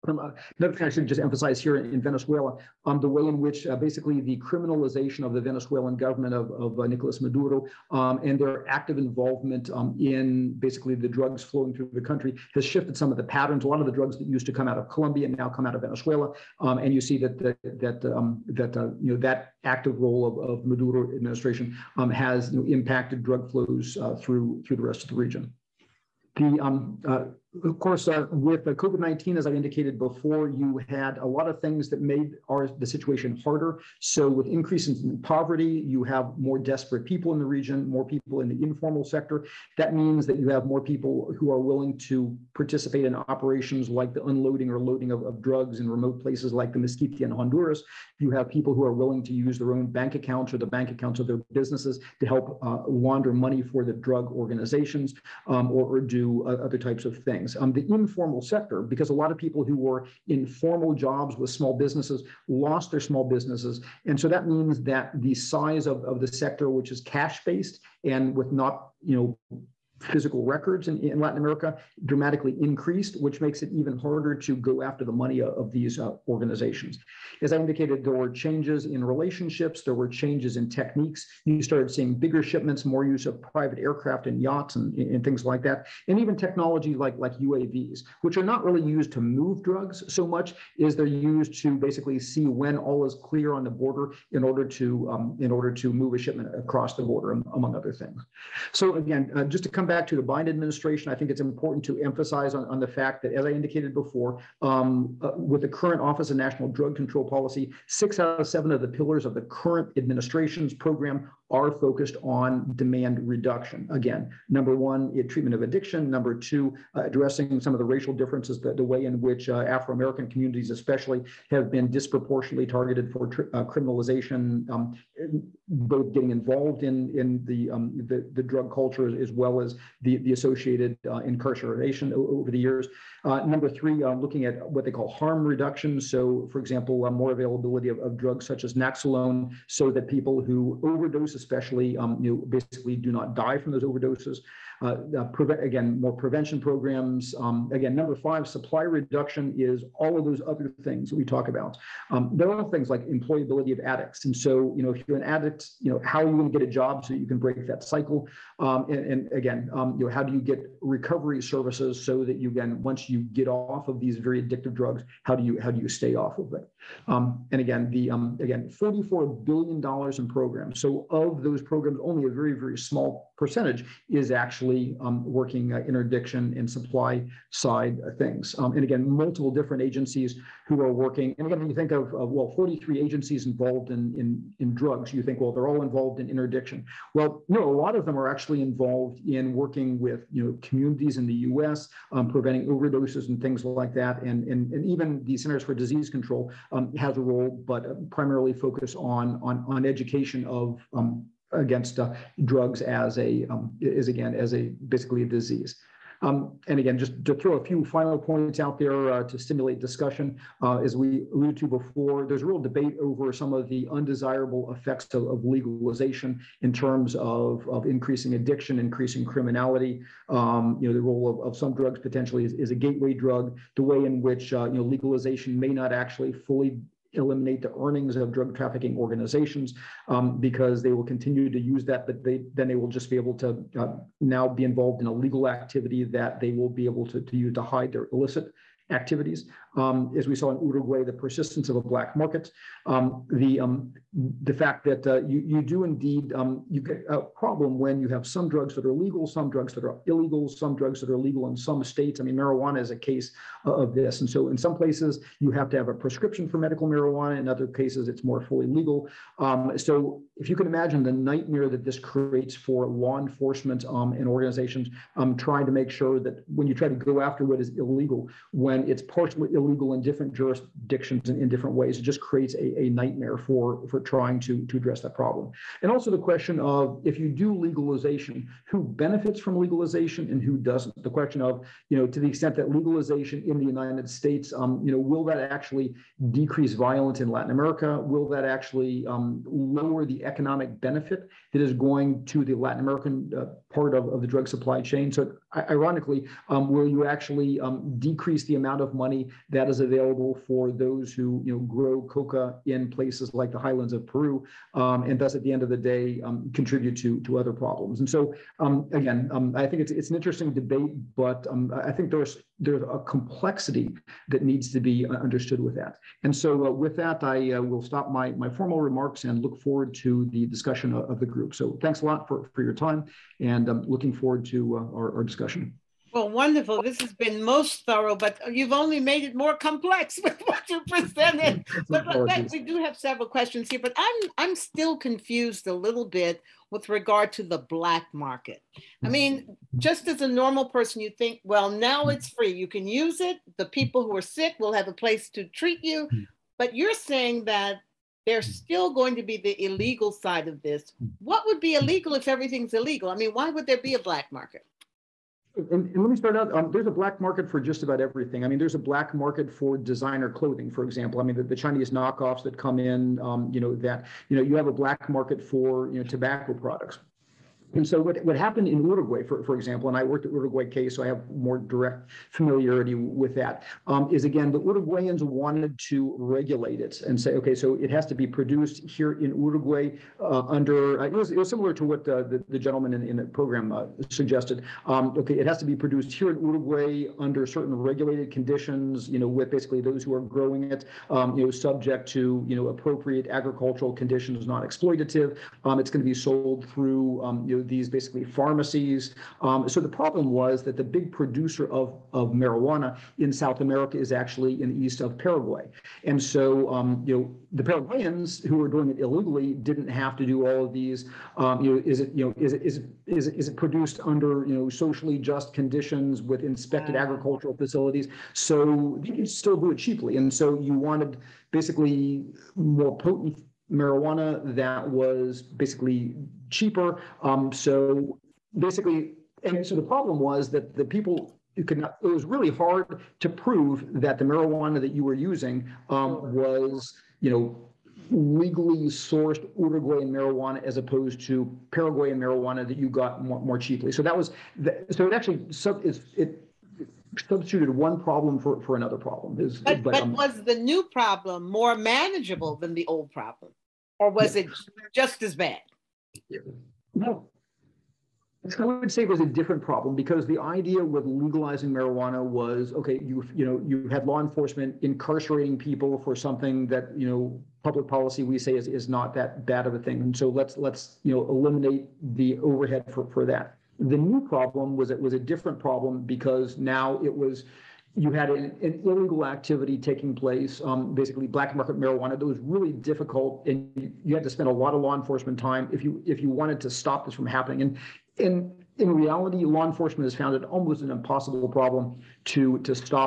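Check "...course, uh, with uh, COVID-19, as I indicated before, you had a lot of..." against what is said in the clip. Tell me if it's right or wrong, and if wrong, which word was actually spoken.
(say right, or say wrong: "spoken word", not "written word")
right.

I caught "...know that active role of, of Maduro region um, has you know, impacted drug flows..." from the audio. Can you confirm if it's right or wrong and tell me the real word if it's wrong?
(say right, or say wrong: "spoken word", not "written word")
wrong: "administration", not "region".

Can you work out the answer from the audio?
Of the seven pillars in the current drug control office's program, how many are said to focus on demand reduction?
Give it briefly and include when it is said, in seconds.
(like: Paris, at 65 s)
6, at 107 s.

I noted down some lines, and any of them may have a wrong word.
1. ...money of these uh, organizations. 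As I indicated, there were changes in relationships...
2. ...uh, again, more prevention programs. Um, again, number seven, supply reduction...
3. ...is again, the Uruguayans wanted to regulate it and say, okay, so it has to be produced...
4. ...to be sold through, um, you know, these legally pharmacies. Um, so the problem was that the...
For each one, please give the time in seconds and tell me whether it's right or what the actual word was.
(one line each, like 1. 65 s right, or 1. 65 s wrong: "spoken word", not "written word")
1. 75 s right
2. 145 s wrong: "five", not "seven"
3. 374 s right
4. 396 s wrong: "basically", not "legally".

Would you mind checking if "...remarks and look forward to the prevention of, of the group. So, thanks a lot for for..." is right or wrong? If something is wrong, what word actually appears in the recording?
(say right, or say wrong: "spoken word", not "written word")
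wrong: "discussion", not "prevention".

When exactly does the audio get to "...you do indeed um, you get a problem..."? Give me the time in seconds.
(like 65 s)
245 s.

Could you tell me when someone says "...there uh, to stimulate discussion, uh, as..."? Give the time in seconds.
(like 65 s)
208 s.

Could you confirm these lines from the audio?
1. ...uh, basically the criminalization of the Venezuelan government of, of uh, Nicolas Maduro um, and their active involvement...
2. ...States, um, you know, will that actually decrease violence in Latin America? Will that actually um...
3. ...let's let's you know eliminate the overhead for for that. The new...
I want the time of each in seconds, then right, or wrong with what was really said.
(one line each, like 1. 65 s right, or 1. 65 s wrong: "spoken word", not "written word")
1. 3 s right
2. 284 s right
3. 470 s right.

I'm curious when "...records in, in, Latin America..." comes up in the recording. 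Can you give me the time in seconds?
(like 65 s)
70 s.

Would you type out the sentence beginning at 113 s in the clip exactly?
Again, number one, treatment of addiction.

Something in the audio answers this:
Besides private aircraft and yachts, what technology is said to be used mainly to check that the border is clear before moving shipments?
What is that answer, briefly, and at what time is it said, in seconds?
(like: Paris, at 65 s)
UAVs, at 87 s.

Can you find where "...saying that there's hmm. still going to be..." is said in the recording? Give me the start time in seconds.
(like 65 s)
347 s.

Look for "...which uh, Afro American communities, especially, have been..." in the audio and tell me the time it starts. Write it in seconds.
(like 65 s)
119 s.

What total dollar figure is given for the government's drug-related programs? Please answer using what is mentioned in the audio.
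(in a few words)
$44 billion.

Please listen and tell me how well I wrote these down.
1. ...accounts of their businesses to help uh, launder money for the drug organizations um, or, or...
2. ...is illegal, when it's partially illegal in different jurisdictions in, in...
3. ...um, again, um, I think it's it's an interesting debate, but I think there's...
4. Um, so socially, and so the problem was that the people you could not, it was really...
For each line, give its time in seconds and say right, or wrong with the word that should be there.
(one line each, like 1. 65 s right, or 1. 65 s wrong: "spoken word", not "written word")
1. 50 s right
2. 267 s right
3. 308 s right
4. 427 s wrong: "basically", not "socially".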